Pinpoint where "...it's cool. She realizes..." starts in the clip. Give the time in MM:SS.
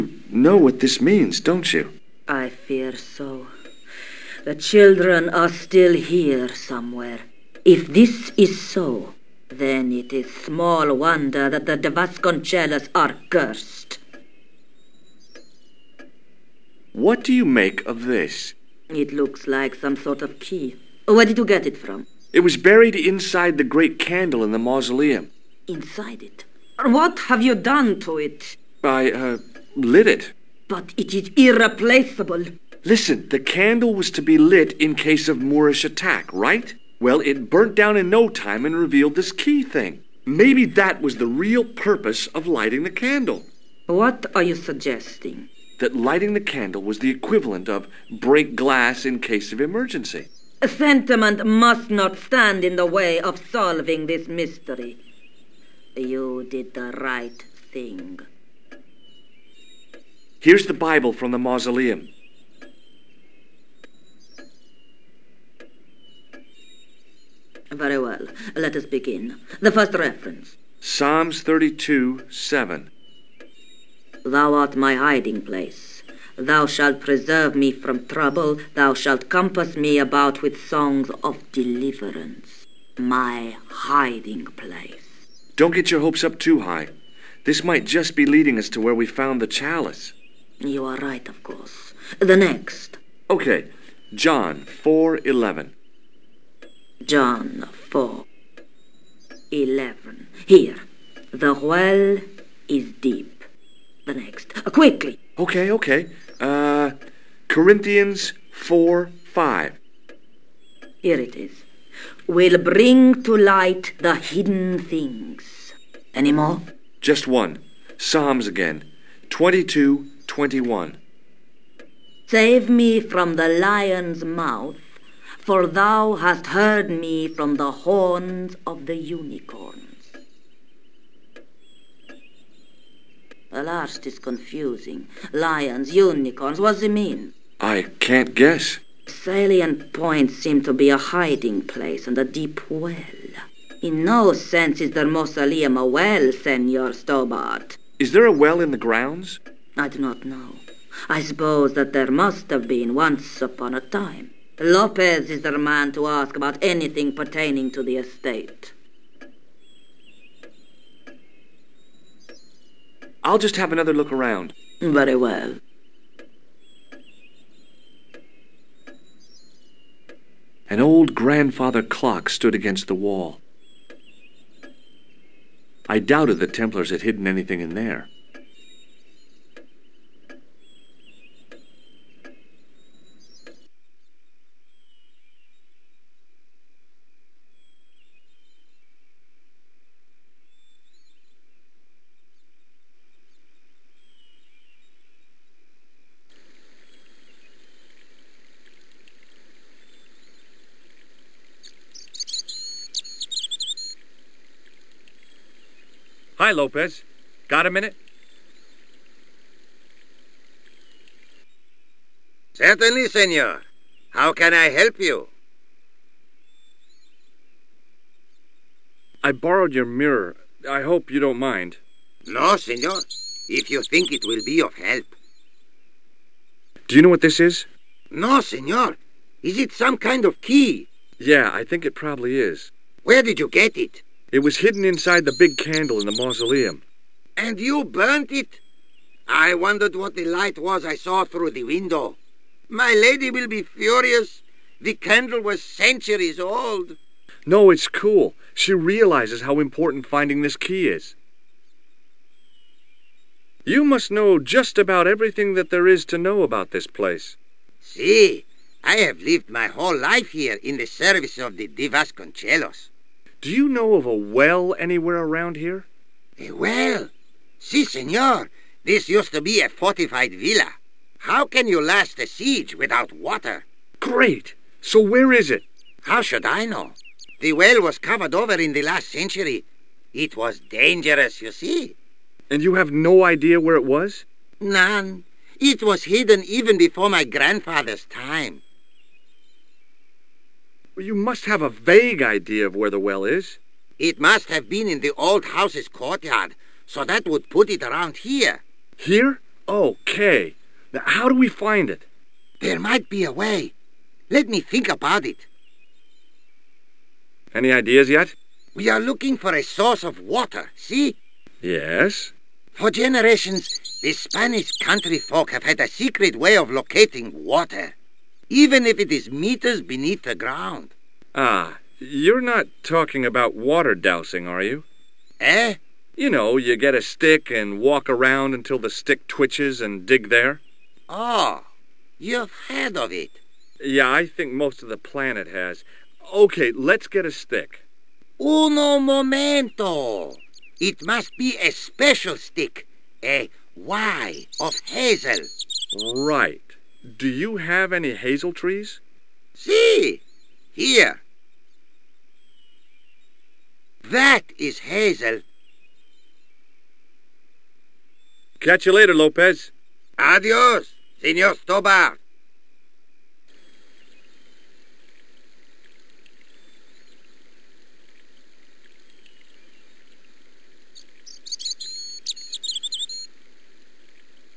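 04:07.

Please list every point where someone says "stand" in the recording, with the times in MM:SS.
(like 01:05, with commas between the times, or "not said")
00:52.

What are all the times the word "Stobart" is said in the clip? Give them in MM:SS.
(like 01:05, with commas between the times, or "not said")
02:26, 06:01.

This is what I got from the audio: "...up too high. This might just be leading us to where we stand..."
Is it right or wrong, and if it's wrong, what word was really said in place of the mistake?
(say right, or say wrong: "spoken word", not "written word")
wrong: "found", not "stand".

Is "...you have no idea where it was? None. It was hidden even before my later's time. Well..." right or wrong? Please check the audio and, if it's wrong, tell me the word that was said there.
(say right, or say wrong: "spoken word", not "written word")
wrong: "grandfather", not "later".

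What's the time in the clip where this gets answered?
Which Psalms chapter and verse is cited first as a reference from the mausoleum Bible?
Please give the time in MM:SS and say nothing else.
01:10.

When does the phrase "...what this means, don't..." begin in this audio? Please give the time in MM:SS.
00:00.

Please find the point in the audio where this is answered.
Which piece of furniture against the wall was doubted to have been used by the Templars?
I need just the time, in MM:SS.
02:51.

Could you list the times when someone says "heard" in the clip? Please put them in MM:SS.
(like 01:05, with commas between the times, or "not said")
02:06, 05:32.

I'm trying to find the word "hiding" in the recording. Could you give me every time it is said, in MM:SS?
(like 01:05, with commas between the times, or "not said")
01:14, 01:23, 02:20.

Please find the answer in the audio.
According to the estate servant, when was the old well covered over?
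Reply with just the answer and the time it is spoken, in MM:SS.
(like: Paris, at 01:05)
In the last century, at 04:38.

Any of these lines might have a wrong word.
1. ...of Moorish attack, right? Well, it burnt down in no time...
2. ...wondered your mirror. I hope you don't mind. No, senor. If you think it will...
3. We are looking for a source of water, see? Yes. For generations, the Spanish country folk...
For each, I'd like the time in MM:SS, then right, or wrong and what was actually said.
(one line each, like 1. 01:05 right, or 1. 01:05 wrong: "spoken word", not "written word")
1. 00:35 right
2. 03:39 wrong: "borrowed", not "wondered"
3. 05:08 right.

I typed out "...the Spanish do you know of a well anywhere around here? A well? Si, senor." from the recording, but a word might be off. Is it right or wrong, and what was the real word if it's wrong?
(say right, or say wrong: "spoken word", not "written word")
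wrong: "Divas", not "Spanish".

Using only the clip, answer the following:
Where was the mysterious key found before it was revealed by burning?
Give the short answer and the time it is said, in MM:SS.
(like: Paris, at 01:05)
Inside the great candle, at 00:22.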